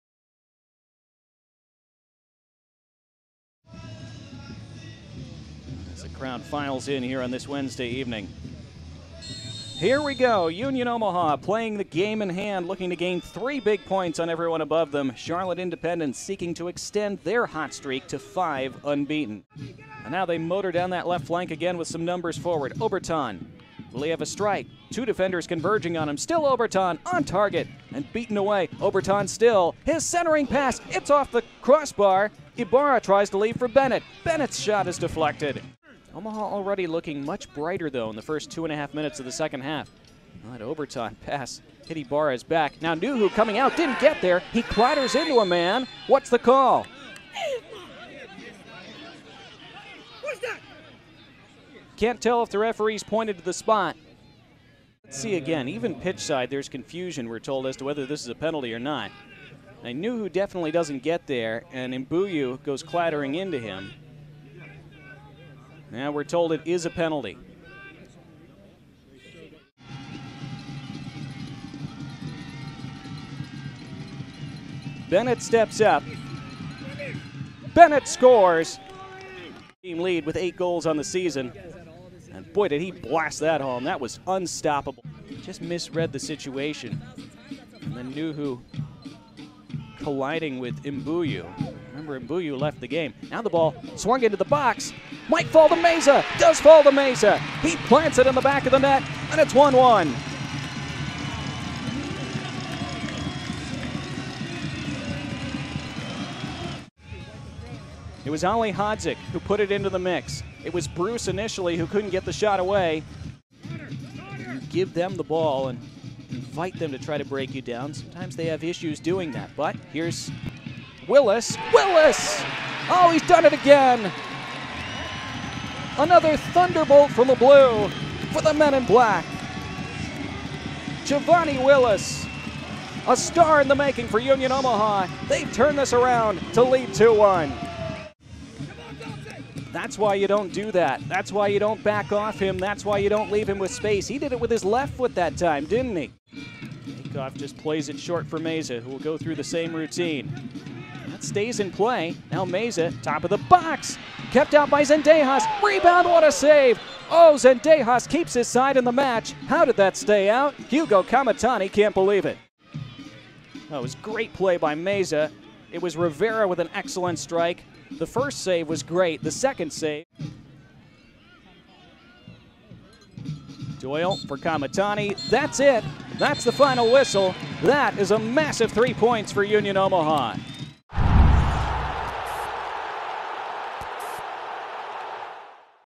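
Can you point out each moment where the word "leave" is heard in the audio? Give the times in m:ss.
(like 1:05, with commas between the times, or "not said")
0:33, 2:23.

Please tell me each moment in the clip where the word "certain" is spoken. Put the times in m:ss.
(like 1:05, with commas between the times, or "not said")
not said.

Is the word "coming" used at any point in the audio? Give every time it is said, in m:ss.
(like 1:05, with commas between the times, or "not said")
0:43.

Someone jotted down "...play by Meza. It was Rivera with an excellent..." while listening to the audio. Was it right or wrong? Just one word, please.
right.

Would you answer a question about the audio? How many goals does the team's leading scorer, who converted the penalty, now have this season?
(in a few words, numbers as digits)
8.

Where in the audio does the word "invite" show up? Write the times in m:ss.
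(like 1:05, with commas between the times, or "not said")
1:56.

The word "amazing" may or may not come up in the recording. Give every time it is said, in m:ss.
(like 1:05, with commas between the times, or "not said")
not said.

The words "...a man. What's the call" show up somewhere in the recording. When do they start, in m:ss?
0:45.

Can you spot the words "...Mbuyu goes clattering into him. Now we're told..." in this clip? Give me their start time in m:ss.
1:02.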